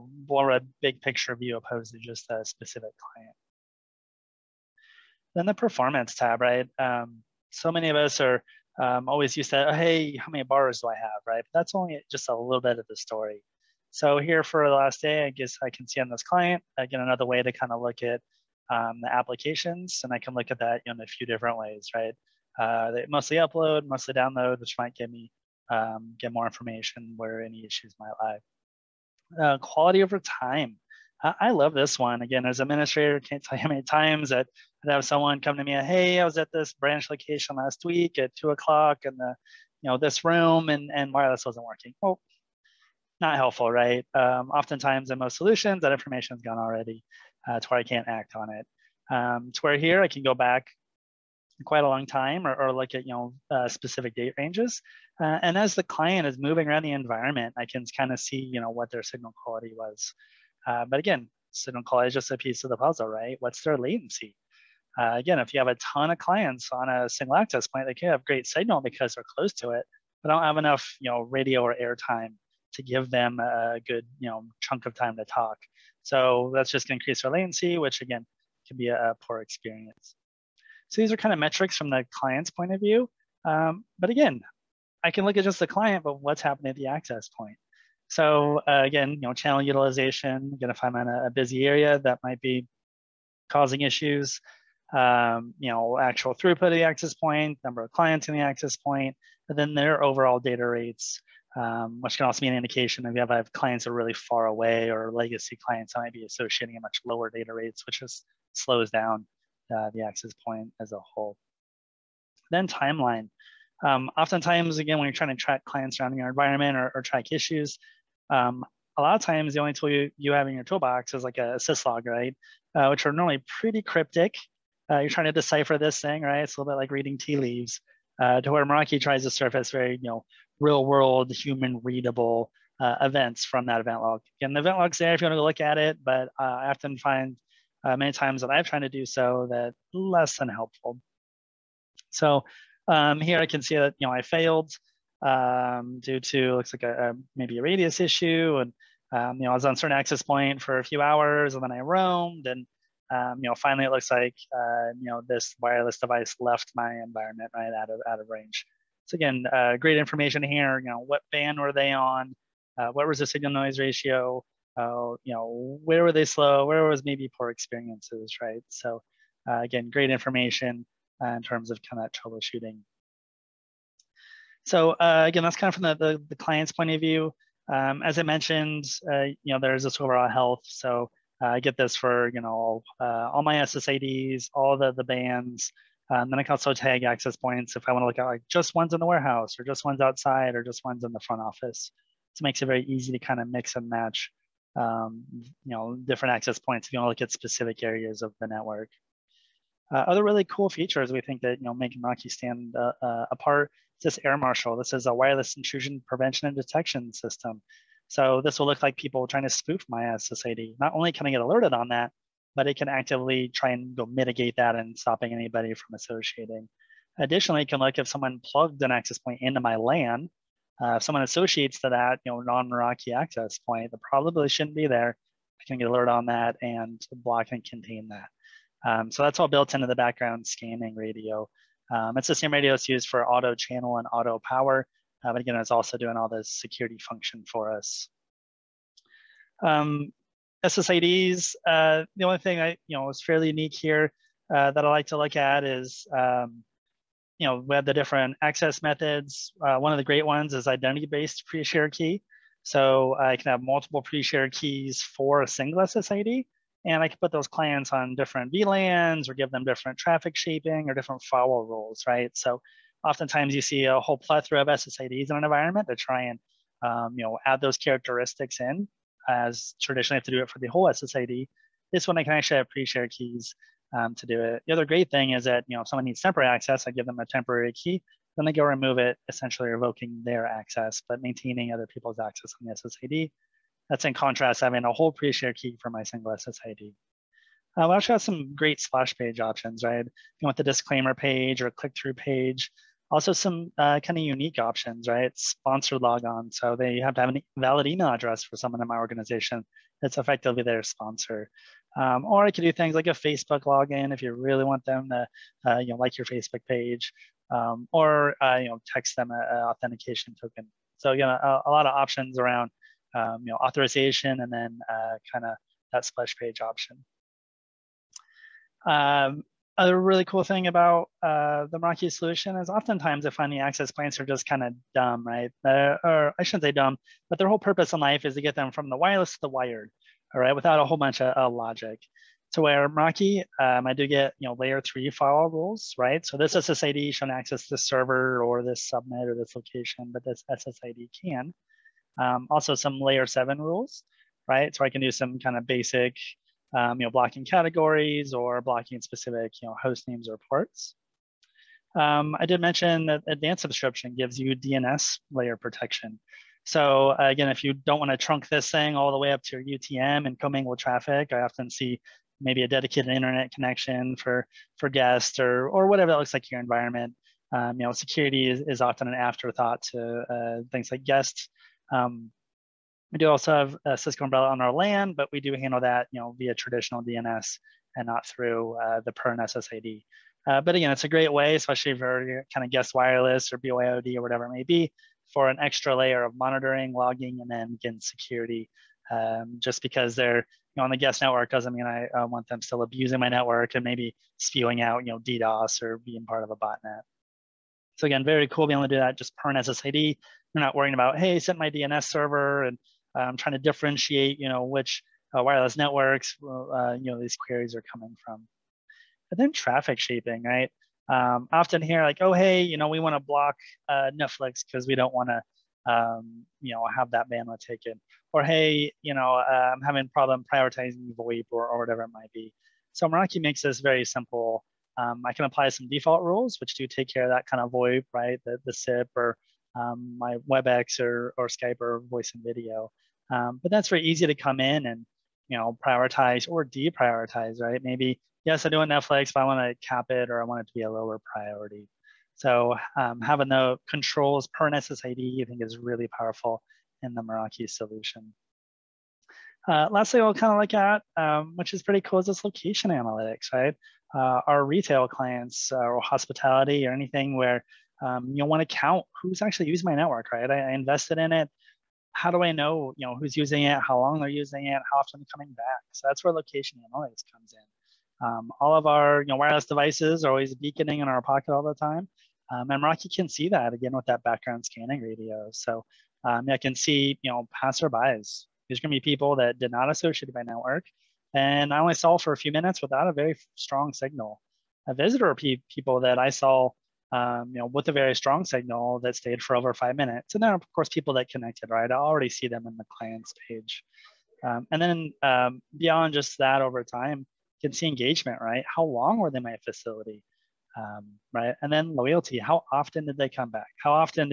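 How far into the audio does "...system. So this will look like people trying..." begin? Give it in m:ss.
3:27.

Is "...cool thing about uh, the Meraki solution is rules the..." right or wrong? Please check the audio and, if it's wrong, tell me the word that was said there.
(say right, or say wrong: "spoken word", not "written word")
wrong: "oftentimes", not "rules".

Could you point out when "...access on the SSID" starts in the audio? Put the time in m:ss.
4:42.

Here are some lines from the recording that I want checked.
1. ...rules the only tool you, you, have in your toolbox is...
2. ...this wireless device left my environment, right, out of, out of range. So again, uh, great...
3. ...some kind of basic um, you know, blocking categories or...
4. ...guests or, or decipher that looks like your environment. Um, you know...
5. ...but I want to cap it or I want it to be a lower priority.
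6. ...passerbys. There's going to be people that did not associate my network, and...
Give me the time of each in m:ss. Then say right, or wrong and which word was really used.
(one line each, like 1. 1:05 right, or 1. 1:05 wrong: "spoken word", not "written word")
1. 1:59 wrong: "times", not "rules"
2. 2:35 right
3. 5:45 right
4. 6:04 wrong: "whatever", not "decipher"
5. 7:19 right
6. 7:57 right.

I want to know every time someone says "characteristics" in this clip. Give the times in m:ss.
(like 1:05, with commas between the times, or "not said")
4:27.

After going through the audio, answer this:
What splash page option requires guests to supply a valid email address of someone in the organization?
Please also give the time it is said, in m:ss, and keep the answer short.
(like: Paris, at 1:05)
Sponsored logon, at 4:55.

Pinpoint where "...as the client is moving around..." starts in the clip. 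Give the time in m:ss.
0:55.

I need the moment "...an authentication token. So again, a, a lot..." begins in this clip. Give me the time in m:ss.
5:09.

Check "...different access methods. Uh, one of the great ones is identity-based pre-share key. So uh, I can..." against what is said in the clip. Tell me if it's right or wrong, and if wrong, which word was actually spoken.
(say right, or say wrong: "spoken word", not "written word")
right.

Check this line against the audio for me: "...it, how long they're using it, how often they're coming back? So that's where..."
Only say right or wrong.
right.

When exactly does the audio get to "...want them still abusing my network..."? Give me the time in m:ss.
6:32.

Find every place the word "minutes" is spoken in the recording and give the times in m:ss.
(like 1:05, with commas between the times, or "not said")
8:02, 8:09.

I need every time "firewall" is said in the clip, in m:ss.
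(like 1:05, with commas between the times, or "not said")
4:21, 5:35.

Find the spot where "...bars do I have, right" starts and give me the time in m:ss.
0:10.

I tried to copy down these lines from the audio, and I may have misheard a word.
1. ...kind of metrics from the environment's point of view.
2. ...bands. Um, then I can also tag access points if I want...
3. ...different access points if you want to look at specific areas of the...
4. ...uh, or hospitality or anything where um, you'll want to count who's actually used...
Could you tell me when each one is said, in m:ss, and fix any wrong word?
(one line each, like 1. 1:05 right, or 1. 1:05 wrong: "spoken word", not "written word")
1. 1:21 wrong: "client", not "environment"
2. 3:05 right
3. 3:15 right
4. 7:35 right.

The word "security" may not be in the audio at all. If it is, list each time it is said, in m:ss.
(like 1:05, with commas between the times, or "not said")
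3:56, 6:07, 6:28.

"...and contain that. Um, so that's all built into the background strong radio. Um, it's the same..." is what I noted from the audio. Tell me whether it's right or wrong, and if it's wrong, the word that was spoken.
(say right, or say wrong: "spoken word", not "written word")
wrong: "scanning", not "strong".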